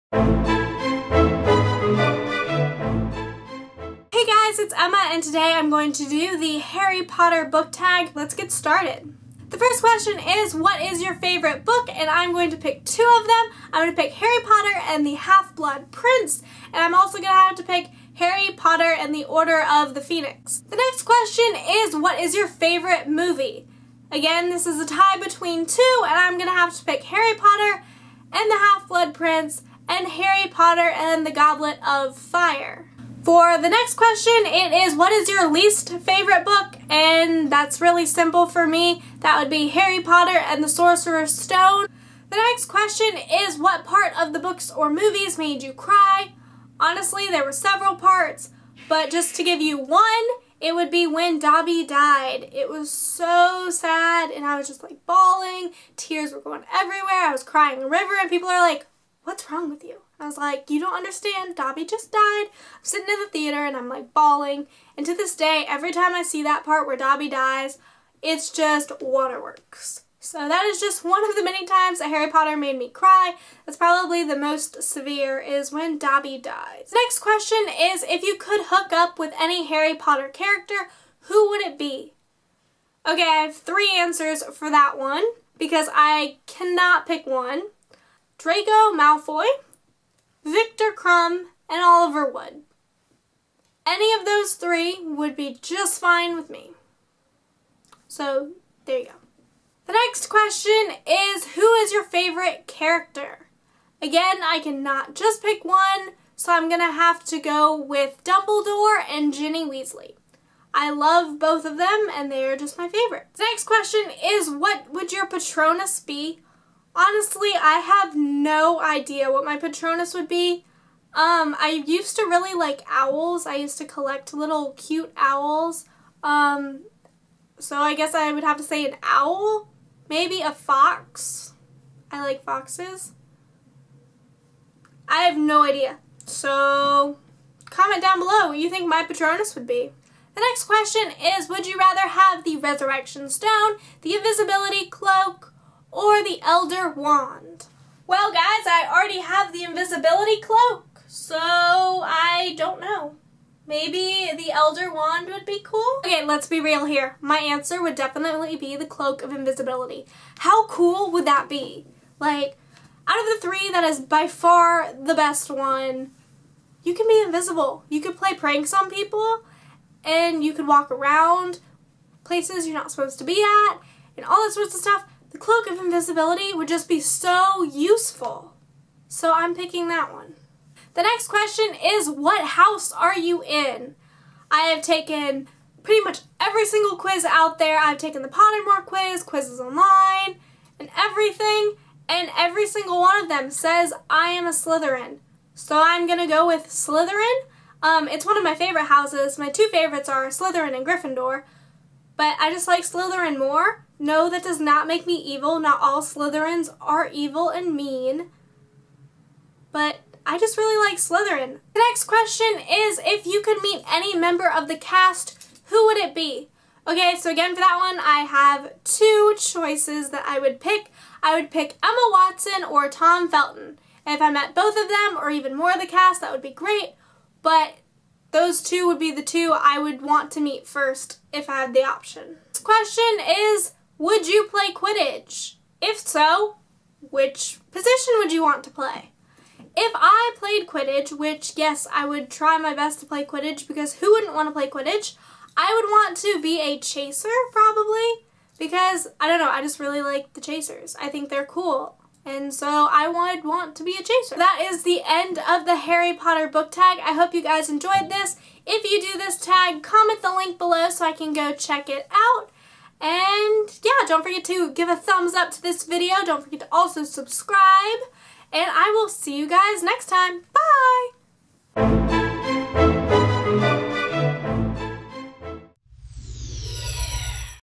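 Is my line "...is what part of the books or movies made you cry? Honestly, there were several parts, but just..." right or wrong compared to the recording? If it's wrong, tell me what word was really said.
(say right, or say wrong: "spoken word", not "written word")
right.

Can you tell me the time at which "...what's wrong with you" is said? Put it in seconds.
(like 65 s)
59 s.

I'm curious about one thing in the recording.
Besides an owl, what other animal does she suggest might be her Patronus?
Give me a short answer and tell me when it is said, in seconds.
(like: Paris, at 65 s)
A fox, at 130 s.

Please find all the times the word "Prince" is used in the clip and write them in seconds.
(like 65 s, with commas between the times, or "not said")
15 s, 29 s.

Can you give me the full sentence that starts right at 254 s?
That is the end of the Harry Potter book tag.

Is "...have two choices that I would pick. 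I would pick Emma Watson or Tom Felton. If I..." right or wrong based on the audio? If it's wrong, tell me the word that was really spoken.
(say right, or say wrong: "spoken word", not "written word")
right.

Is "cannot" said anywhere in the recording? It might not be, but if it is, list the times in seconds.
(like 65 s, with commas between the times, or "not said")
86 s, 104 s.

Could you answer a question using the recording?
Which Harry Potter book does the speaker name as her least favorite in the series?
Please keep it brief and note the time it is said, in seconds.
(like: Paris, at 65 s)
Harry Potter and the Sorcerer's Stone, at 39 s.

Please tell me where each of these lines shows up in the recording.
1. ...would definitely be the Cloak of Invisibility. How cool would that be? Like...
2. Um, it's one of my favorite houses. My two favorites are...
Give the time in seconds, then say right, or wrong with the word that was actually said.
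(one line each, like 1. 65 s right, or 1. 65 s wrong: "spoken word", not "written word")
1. 157 s right
2. 197 s right.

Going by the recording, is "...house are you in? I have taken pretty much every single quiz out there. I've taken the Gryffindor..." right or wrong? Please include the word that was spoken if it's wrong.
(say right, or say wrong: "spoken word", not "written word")
wrong: "Pottermore", not "Gryffindor".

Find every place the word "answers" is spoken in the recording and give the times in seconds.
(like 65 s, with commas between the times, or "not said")
83 s, 157 s.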